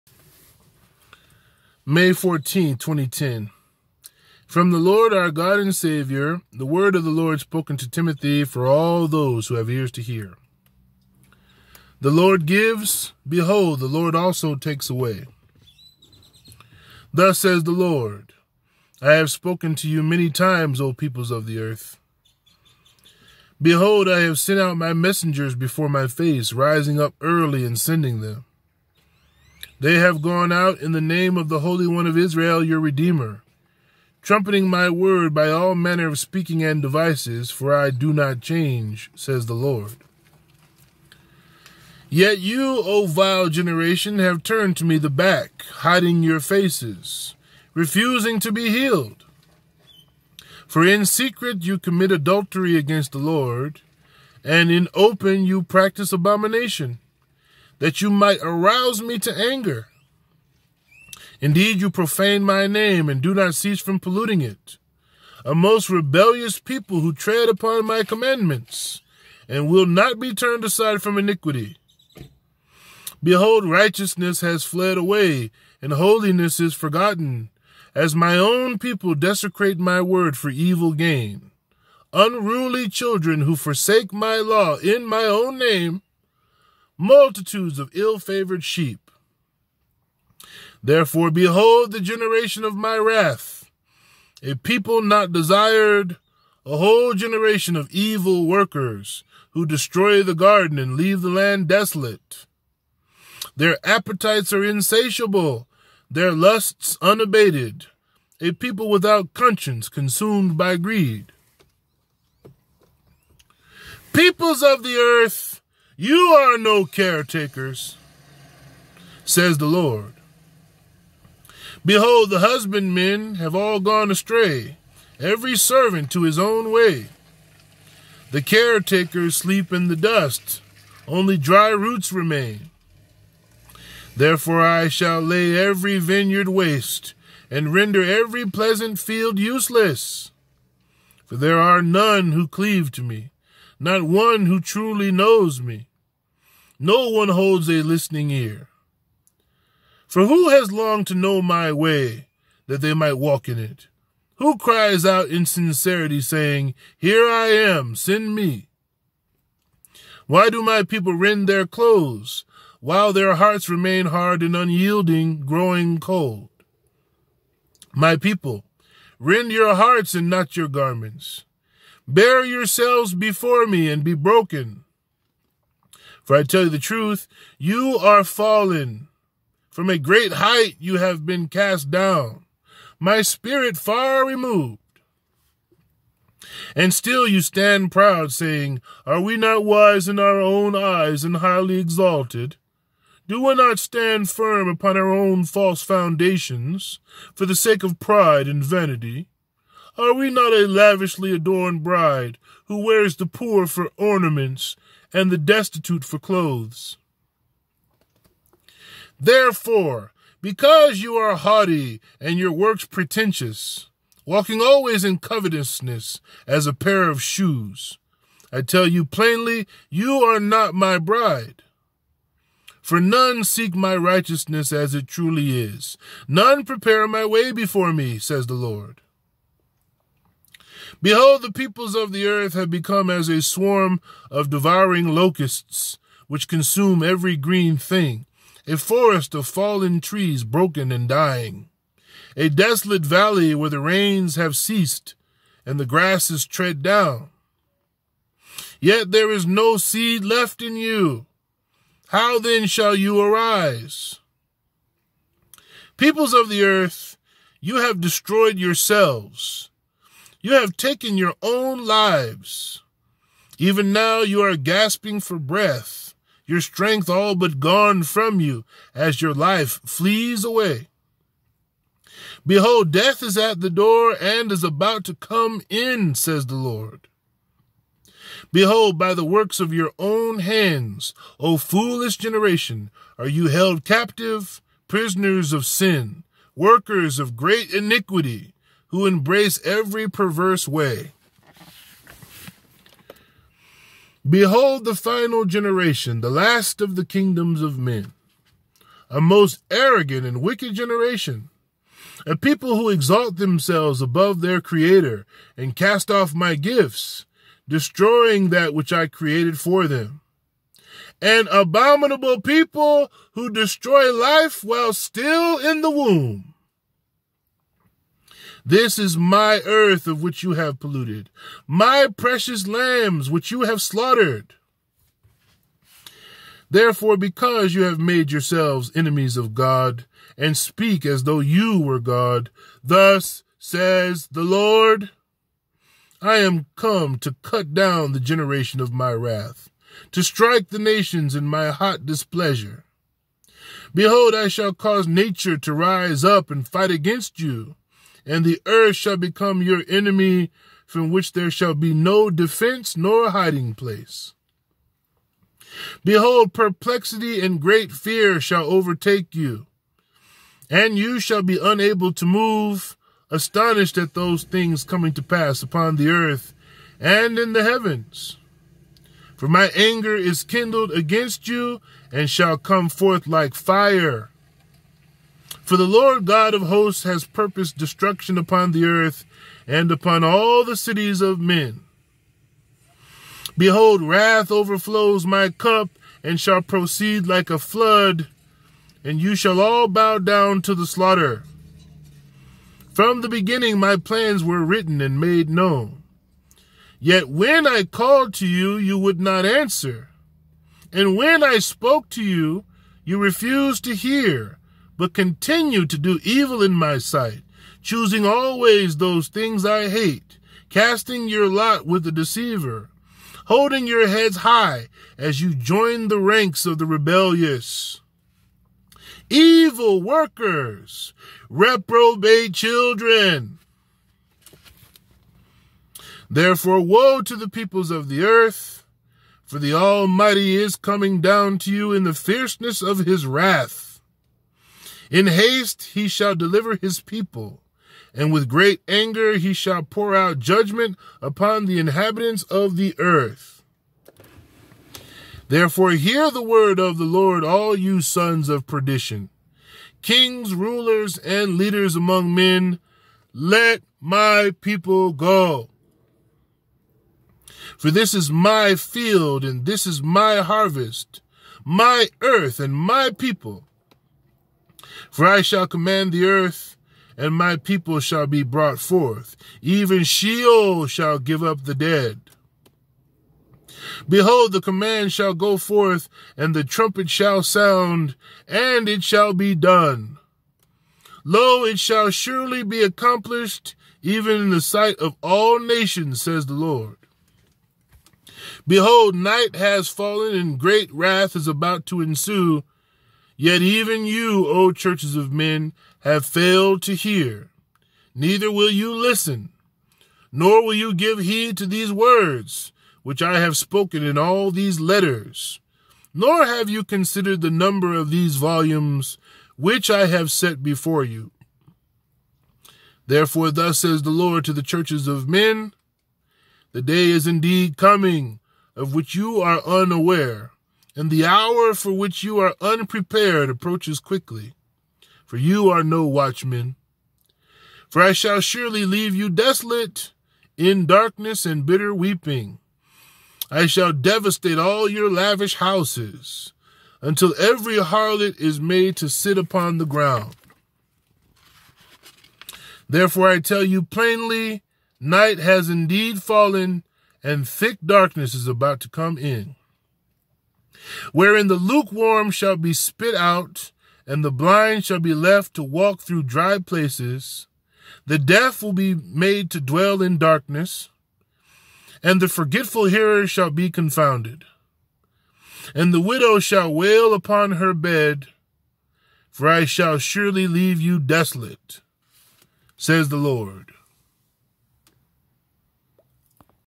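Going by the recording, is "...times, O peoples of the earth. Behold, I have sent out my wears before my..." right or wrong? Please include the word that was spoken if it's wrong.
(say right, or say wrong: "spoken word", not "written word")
wrong: "messengers", not "wears".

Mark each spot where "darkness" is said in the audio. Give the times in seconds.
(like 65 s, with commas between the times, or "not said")
530 s, 547 s, 560 s.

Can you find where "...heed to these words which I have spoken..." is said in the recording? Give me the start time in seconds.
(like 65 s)
501 s.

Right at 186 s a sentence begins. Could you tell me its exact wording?
And still you stand proud, saying, Are we not wise in our own eyes and highly exalted?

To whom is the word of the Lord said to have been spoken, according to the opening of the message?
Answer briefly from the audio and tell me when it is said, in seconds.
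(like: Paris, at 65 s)
Timothy, at 7 s.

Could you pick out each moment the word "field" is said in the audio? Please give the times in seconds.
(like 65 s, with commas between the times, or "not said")
138 s, 458 s.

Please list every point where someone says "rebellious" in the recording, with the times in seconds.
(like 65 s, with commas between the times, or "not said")
65 s, 416 s.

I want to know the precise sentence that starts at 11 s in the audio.
The Lord gives, behold, the Lord also takes away.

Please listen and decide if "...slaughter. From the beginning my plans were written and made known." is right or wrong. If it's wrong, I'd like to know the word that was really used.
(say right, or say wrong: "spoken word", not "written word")
right.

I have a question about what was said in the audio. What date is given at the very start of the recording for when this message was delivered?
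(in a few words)
May 14, 2010.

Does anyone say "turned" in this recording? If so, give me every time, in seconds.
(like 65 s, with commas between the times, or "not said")
44 s, 70 s.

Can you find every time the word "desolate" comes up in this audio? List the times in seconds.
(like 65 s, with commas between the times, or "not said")
101 s, 242 s, 529 s, 570 s.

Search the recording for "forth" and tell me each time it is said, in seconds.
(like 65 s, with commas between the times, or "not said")
372 s, 468 s, 475 s.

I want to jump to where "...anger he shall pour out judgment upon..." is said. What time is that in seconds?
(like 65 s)
438 s.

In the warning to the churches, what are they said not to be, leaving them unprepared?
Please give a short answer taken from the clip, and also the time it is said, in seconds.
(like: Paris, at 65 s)
Watchmen, at 526 s.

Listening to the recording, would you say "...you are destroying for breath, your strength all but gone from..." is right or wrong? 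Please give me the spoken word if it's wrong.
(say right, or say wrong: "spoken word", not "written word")
wrong: "gasping", not "destroying".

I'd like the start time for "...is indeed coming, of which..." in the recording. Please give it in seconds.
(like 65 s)
517 s.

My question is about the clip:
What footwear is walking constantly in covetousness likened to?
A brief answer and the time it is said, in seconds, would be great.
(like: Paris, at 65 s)
A pair of shoes, at 216 s.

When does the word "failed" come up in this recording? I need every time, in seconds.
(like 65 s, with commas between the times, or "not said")
496 s.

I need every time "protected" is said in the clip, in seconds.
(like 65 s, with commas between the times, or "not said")
not said.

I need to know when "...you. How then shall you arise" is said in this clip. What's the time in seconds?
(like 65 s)
250 s.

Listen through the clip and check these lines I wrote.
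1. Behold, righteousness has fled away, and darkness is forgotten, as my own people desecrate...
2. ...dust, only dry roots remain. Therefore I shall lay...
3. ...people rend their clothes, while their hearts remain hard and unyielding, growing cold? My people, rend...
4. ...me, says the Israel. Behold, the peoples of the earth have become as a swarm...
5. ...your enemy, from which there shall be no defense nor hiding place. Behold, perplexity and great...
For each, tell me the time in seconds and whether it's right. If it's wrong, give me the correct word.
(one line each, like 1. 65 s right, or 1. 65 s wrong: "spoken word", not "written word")
1. 73 s wrong: "holiness", not "darkness"
2. 129 s right
3. 160 s right
4. 227 s wrong: "Lord", not "Israel"
5. 349 s right.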